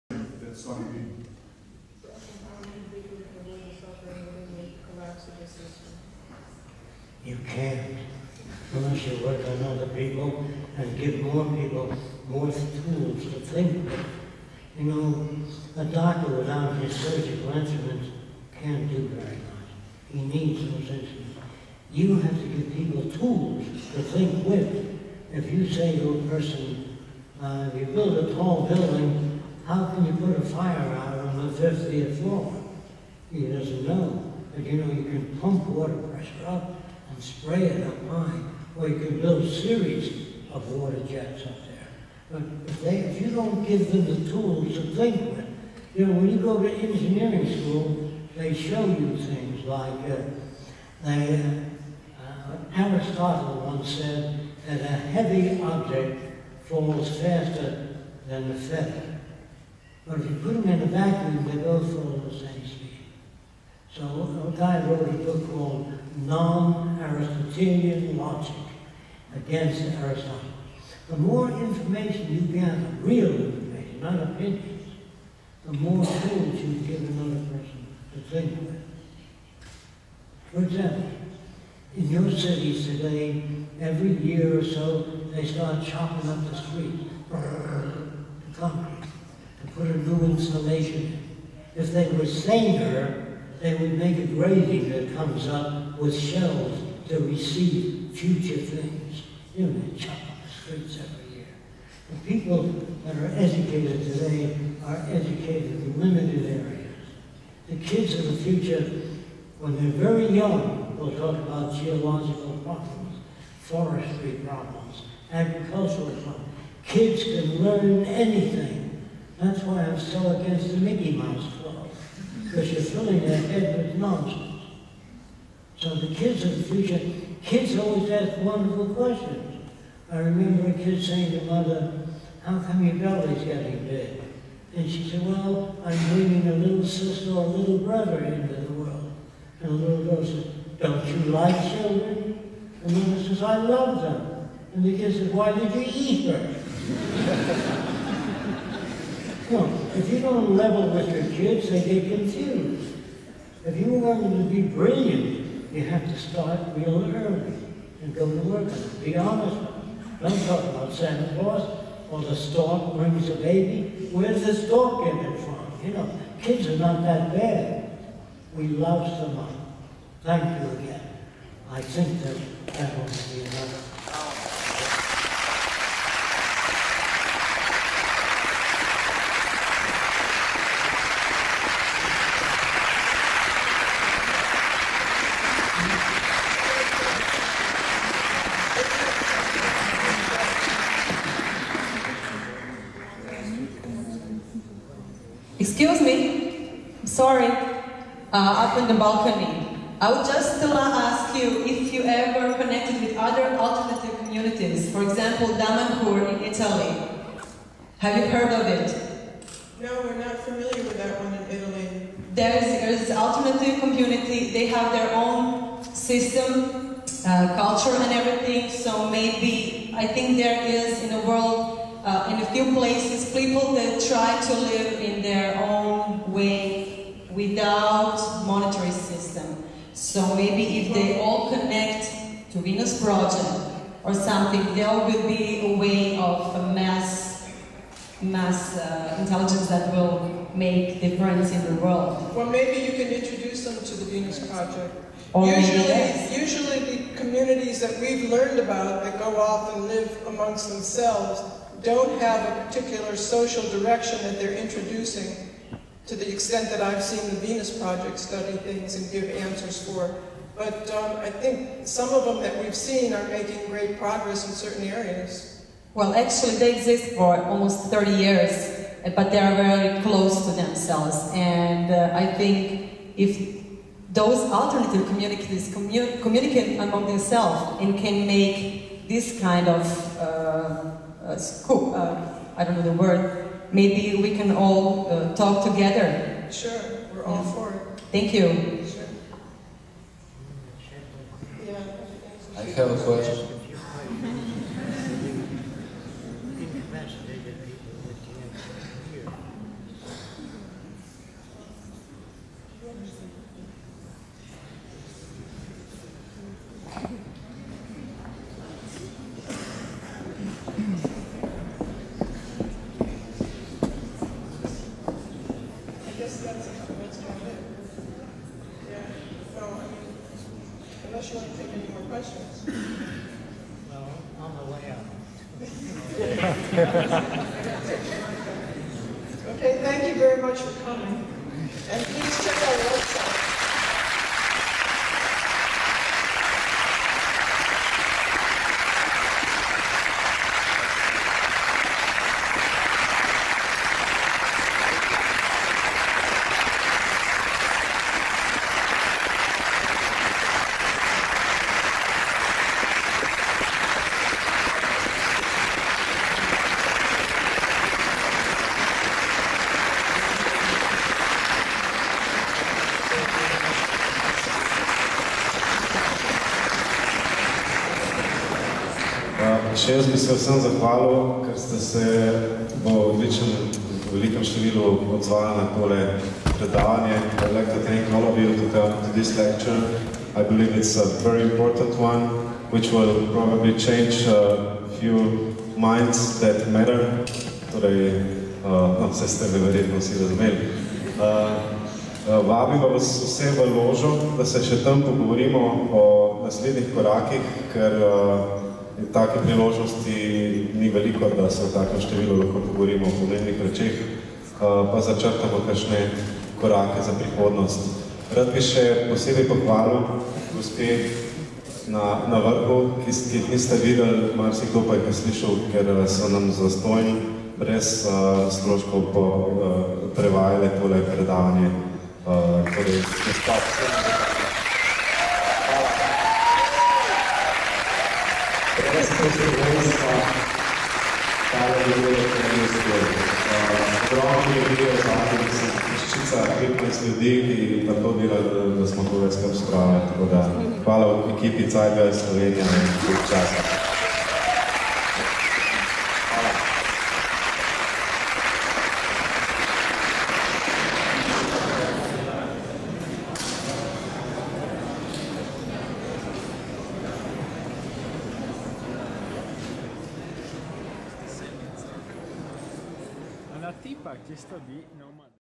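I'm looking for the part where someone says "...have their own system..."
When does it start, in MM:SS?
03:34.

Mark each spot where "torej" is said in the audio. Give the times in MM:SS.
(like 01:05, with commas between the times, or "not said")
06:27, 07:02.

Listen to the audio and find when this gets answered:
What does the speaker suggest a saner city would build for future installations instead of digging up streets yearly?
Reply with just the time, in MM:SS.
01:34.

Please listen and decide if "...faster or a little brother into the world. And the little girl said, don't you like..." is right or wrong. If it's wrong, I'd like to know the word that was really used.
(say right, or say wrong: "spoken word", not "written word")
wrong: "sister", not "faster".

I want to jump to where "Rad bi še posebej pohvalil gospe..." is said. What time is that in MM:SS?
06:48.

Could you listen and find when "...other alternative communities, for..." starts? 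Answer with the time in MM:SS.
03:23.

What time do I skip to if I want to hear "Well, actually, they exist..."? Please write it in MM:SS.
04:25.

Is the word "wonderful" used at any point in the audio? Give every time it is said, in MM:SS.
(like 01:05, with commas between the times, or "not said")
02:08.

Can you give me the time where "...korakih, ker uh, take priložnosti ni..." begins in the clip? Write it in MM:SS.
06:36.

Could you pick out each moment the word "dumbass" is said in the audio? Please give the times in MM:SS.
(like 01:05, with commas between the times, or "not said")
not said.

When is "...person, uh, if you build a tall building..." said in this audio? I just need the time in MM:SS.
00:26.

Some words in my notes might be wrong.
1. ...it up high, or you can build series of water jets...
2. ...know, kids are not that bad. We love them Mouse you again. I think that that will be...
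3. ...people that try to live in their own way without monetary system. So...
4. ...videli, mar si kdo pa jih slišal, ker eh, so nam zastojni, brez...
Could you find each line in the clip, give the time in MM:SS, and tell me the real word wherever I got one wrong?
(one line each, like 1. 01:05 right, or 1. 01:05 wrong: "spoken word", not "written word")
1. 00:37 right
2. 02:45 wrong: "Thank", not "Mouse"
3. 03:43 right
4. 06:53 right.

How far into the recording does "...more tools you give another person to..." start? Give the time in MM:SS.
01:15.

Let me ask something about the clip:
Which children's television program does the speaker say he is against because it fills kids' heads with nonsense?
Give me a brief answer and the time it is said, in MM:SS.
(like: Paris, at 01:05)
Mickey Mouse Club, at 02:00.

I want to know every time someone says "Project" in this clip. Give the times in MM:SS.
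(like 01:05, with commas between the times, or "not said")
03:53, 04:04, 04:17.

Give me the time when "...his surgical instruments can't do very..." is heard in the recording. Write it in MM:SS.
00:16.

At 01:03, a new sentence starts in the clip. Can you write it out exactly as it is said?
So a guy wrote a book called Non-Aristotelian Logic against Aristotle.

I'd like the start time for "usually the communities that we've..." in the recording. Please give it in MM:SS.
04:06.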